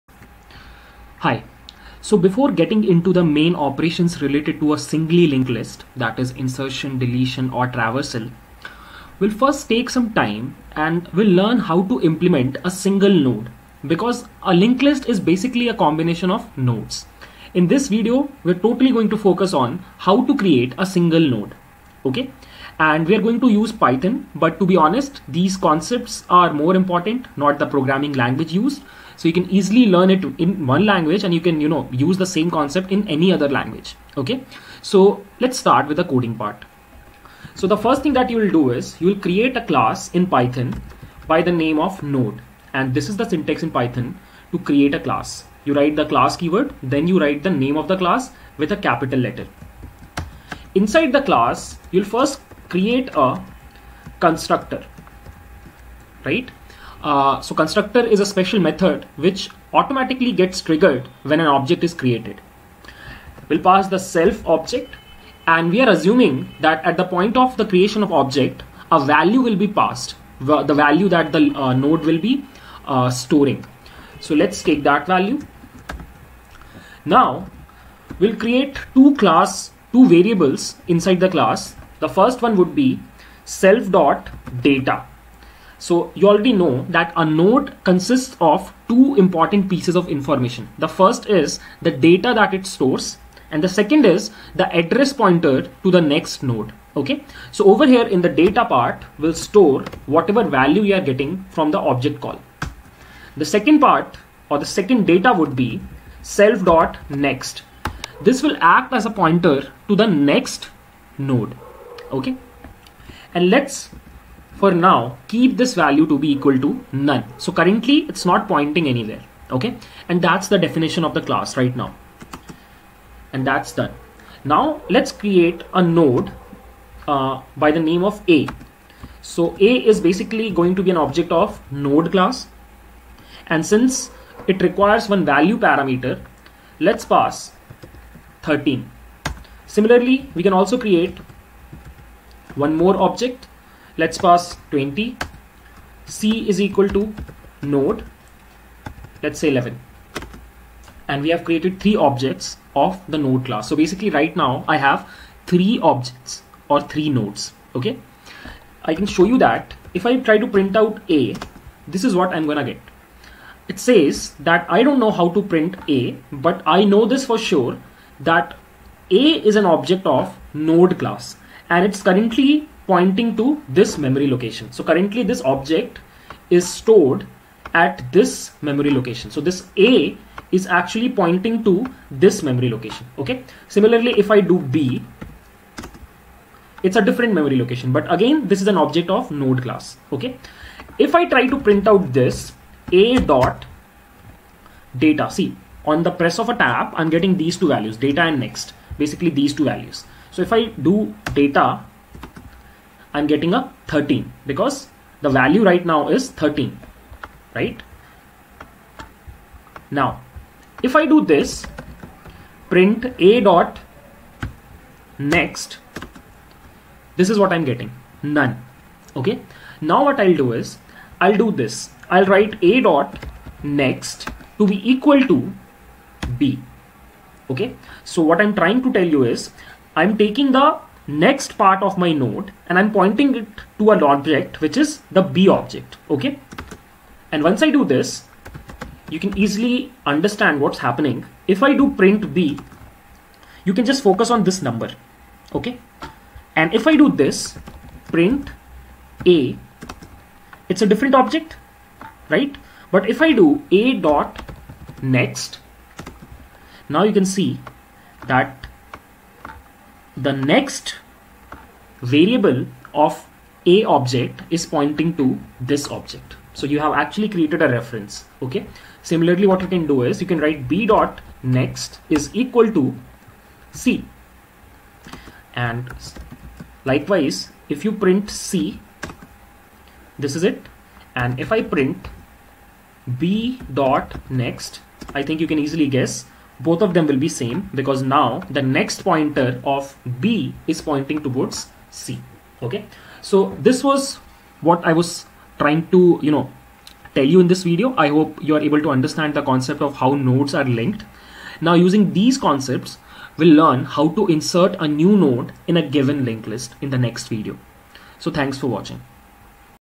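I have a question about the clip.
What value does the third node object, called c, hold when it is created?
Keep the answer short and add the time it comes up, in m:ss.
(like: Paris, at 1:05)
11, at 2:26.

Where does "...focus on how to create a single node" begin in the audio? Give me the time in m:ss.
0:19.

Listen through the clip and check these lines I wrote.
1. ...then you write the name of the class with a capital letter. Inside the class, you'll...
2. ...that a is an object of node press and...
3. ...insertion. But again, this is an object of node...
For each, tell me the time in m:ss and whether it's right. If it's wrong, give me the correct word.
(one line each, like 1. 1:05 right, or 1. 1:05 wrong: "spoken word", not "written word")
1. 0:46 right
2. 2:48 wrong: "class", not "press"
3. 3:07 wrong: "location", not "insertion".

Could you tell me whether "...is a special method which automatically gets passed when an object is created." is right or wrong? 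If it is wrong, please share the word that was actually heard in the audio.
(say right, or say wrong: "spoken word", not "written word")
wrong: "triggered", not "passed".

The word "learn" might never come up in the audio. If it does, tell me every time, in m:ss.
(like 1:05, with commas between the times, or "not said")
0:11, 0:29, 5:03.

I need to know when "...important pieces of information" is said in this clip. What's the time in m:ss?
1:29.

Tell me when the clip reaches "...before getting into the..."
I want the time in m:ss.
0:02.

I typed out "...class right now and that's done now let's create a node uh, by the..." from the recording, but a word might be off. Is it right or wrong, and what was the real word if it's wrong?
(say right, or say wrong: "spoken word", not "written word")
right.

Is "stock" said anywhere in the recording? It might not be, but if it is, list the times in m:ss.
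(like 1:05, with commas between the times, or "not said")
not said.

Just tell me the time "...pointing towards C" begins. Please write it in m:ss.
4:50.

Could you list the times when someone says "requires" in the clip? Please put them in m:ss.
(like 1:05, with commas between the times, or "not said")
2:14.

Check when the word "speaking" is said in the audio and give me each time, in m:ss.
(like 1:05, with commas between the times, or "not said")
not said.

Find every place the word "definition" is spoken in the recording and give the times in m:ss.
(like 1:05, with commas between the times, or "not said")
2:00.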